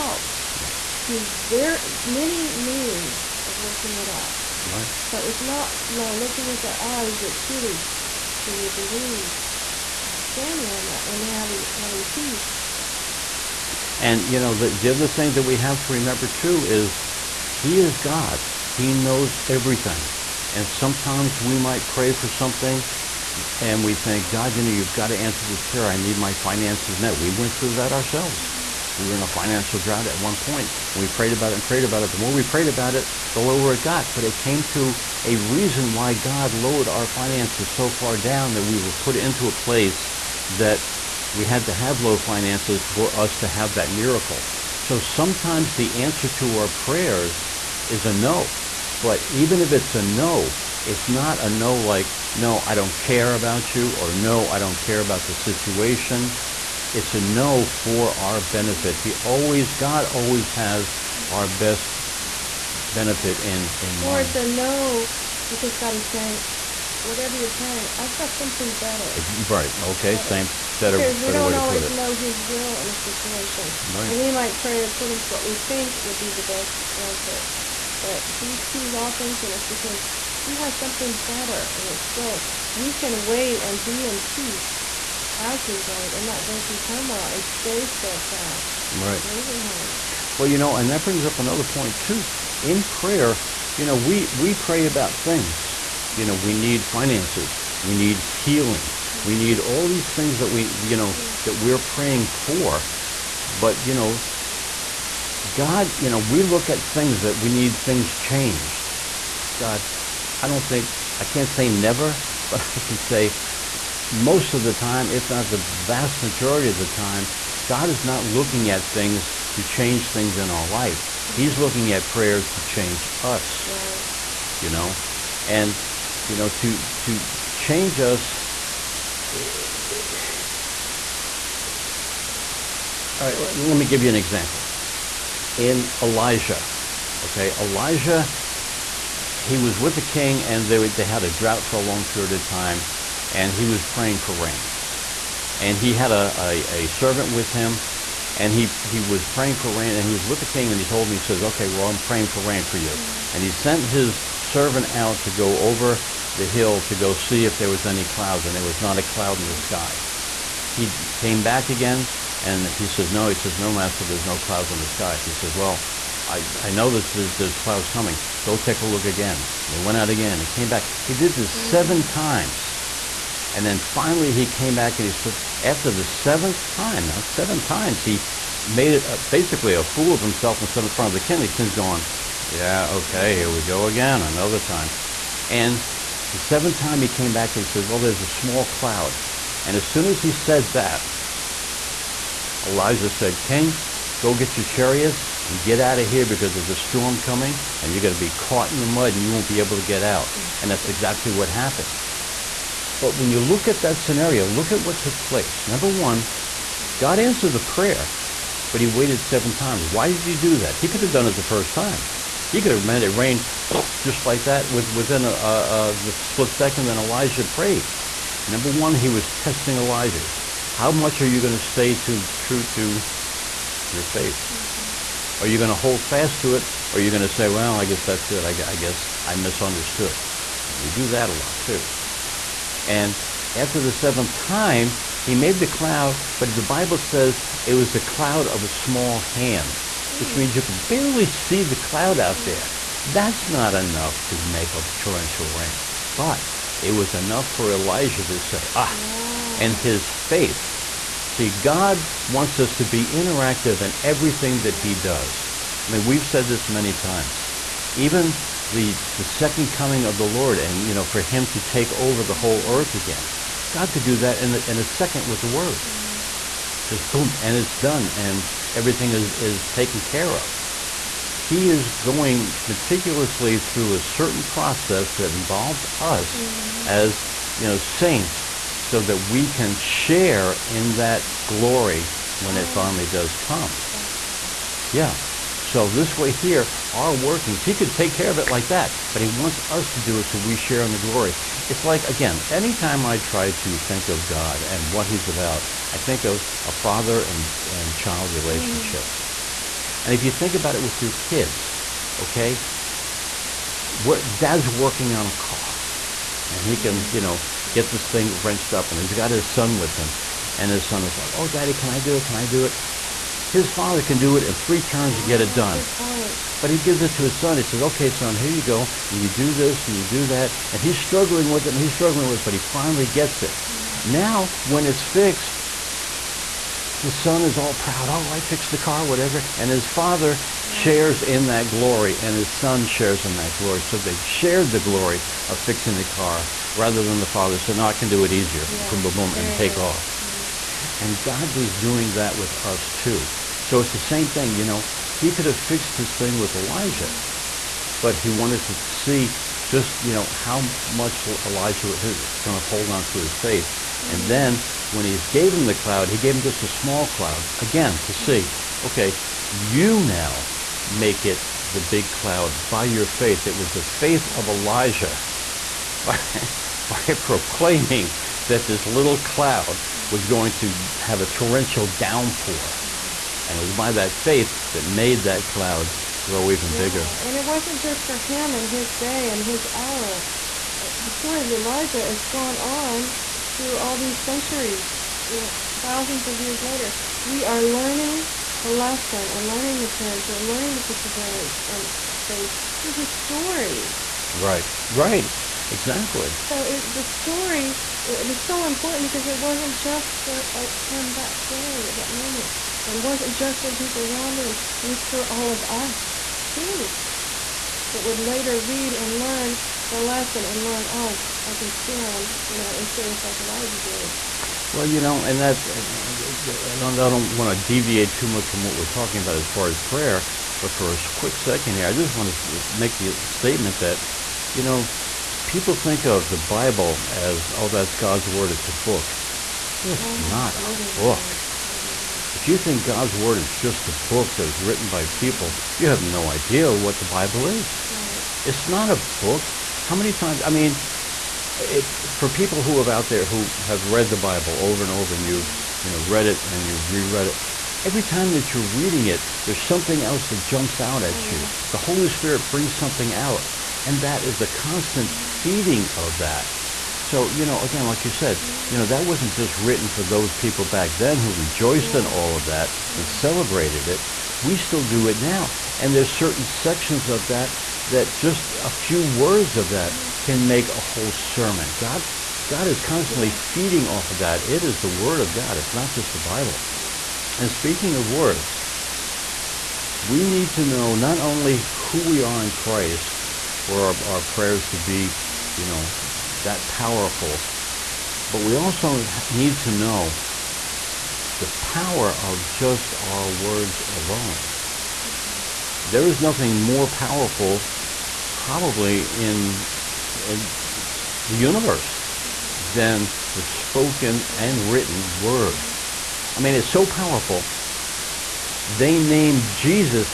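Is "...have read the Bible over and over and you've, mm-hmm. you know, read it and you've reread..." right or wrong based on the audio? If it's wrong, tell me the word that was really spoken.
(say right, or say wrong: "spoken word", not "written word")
right.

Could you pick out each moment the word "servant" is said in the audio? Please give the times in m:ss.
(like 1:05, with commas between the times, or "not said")
2:26, 2:34.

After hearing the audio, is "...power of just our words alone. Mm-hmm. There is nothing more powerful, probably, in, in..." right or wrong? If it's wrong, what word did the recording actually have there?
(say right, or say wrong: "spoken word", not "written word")
right.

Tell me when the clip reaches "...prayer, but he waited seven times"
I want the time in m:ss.
3:27.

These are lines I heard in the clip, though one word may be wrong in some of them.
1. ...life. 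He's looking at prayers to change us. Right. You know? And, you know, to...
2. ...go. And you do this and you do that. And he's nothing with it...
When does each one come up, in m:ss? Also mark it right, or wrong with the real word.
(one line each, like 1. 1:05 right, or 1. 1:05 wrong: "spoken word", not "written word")
1. 2:00 right
2. 5:18 wrong: "struggling", not "nothing".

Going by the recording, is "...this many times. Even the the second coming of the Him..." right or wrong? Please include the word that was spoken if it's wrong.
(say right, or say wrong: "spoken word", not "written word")
wrong: "Lord", not "Him".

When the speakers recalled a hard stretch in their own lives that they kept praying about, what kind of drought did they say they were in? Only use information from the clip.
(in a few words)
Financial drought.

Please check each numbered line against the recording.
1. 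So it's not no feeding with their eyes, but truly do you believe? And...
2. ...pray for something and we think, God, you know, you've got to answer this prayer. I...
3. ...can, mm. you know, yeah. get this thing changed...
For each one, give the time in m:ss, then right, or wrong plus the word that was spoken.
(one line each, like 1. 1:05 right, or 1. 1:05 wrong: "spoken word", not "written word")
1. 0:05 wrong: "looking", not "feeding"
2. 0:21 right
3. 5:06 wrong: "wrenched", not "changed".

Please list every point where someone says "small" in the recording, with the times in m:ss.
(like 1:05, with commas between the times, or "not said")
3:08, 3:58, 5:56.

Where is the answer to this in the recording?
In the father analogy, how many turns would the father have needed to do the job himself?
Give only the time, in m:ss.
5:14.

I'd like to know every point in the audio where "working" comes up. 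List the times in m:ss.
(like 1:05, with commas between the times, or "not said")
0:03, 4:47, 5:04.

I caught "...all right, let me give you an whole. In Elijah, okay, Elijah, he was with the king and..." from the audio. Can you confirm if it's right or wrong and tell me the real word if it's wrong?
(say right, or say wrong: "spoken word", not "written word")
wrong: "example", not "whole".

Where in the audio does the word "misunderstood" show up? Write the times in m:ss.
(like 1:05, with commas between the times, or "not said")
3:49.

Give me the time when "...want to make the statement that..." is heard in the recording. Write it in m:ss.
7:02.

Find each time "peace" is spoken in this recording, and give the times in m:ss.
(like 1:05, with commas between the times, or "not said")
0:12, 1:24.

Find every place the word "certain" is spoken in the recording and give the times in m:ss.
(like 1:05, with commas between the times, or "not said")
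4:34, 7:46.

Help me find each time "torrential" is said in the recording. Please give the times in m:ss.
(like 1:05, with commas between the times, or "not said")
4:04, 6:11.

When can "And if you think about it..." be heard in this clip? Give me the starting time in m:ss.
5:00.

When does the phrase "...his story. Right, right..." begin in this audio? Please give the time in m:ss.
6:32.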